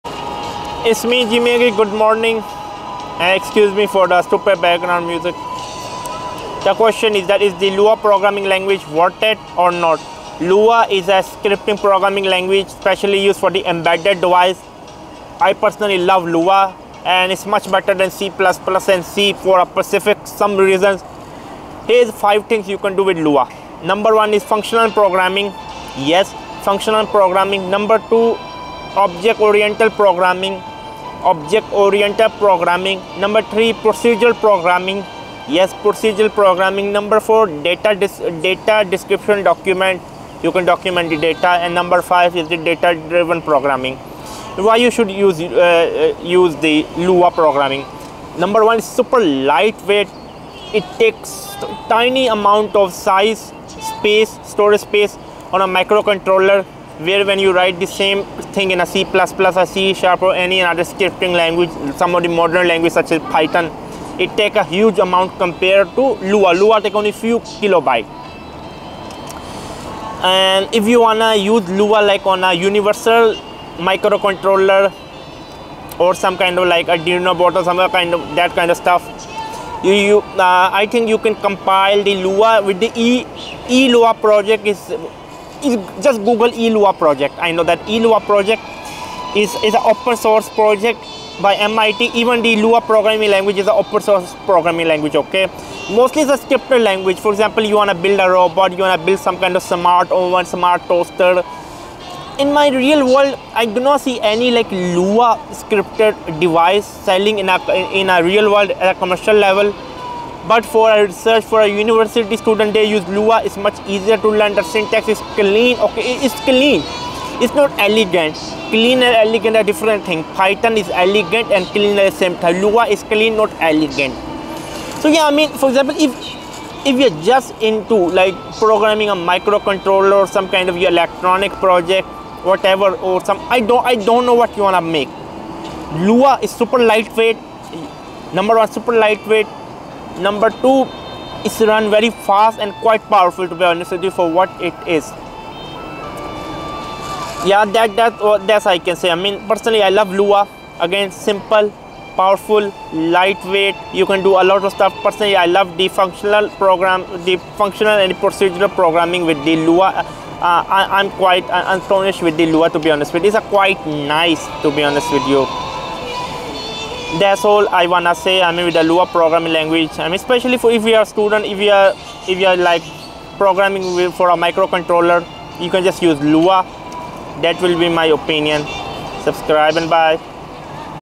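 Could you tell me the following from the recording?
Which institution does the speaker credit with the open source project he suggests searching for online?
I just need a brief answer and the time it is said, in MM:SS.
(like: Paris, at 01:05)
MIT, at 01:31.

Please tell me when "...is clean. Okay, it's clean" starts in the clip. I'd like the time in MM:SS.
01:55.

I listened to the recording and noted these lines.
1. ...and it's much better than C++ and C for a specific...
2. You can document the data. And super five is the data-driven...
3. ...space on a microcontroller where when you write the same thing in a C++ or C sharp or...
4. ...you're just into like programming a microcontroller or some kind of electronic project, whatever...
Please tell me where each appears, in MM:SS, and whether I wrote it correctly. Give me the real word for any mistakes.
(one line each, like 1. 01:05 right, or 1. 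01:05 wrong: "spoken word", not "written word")
1. 00:17 right
2. 00:40 wrong: "number", not "super"
3. 00:54 right
4. 02:06 right.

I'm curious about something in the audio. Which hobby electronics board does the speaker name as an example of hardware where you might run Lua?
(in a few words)
Arduino.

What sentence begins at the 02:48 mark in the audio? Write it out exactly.
I mean, with the Lua programming language.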